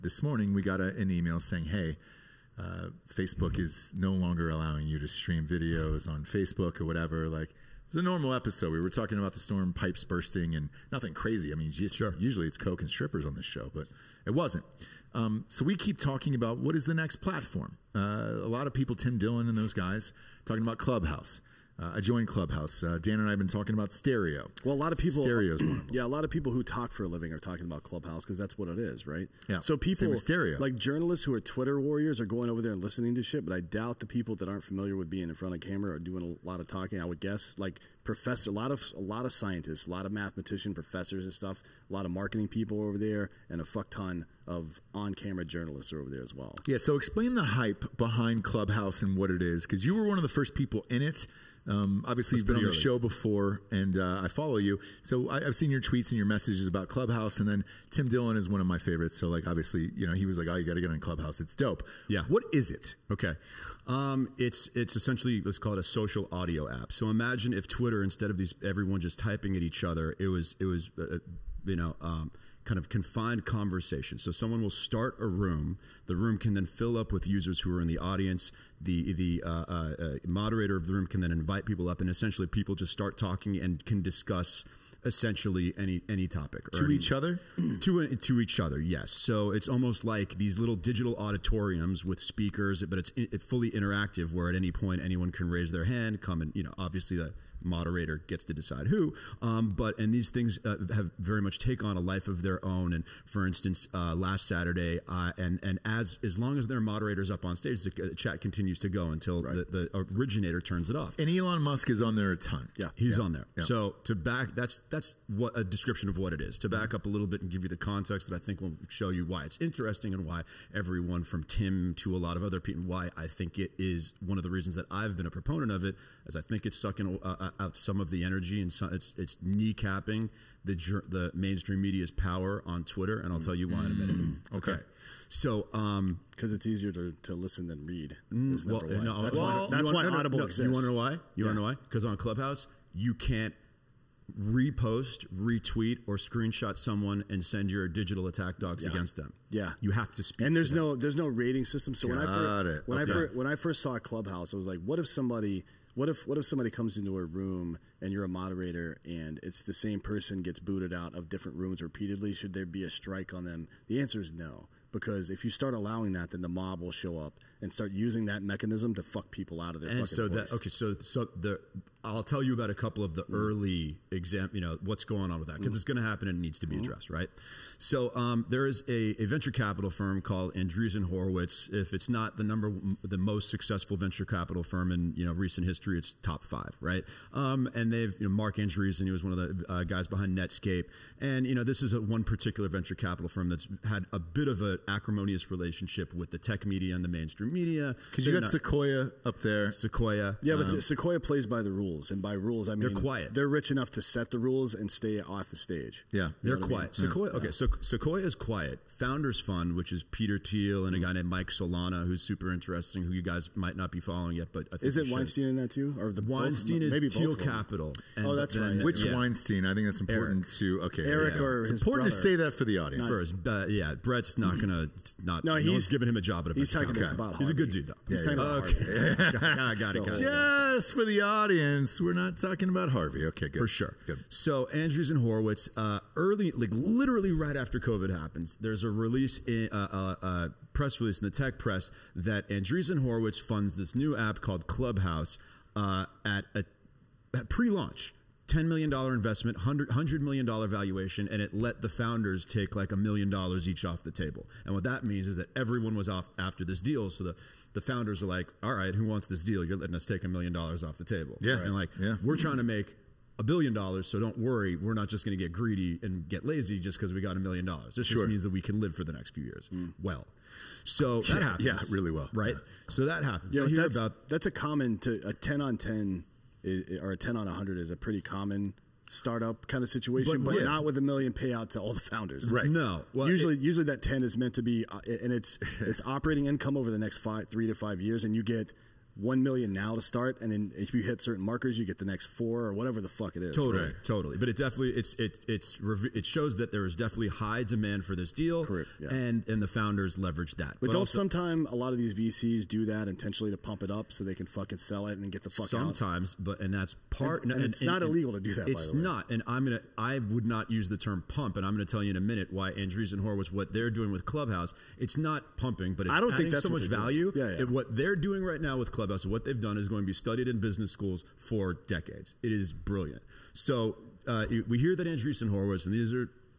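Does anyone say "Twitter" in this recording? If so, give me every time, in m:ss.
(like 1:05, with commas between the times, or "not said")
0:31, 1:07, 2:12.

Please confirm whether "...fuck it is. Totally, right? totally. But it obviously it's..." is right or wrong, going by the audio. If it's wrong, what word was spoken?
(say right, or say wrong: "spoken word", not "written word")
wrong: "definitely", not "obviously".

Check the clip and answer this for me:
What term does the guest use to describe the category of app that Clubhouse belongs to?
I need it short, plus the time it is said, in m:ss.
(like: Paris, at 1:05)
social audio app, at 1:05.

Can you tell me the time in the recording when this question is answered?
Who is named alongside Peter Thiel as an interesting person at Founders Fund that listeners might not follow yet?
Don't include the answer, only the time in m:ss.
3:31.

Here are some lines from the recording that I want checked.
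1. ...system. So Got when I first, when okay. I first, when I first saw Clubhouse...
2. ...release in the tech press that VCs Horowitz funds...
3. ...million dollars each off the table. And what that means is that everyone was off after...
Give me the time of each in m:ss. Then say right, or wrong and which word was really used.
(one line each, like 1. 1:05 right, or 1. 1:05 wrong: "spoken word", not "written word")
1. 2:31 right
2. 4:00 wrong: "Andreessen", not "VCs"
3. 4:12 right.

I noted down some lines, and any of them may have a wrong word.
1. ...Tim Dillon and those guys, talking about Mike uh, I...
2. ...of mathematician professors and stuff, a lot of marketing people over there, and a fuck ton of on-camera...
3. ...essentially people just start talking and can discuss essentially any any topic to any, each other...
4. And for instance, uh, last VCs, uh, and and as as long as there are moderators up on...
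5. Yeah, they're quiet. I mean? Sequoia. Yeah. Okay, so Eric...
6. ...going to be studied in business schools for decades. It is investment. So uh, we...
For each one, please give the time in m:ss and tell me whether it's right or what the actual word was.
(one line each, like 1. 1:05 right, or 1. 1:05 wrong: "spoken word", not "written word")
1. 0:18 wrong: "Clubhouse", not "Mike"
2. 0:40 right
3. 1:22 right
4. 1:42 wrong: "Saturday", not "VCs"
5. 3:26 wrong: "Sequoia", not "Eric"
6. 5:19 wrong: "brilliant", not "investment".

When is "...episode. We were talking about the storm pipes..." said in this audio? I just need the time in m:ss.
0:08.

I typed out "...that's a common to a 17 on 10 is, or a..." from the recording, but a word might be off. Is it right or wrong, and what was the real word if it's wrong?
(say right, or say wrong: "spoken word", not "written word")
wrong: "10", not "17".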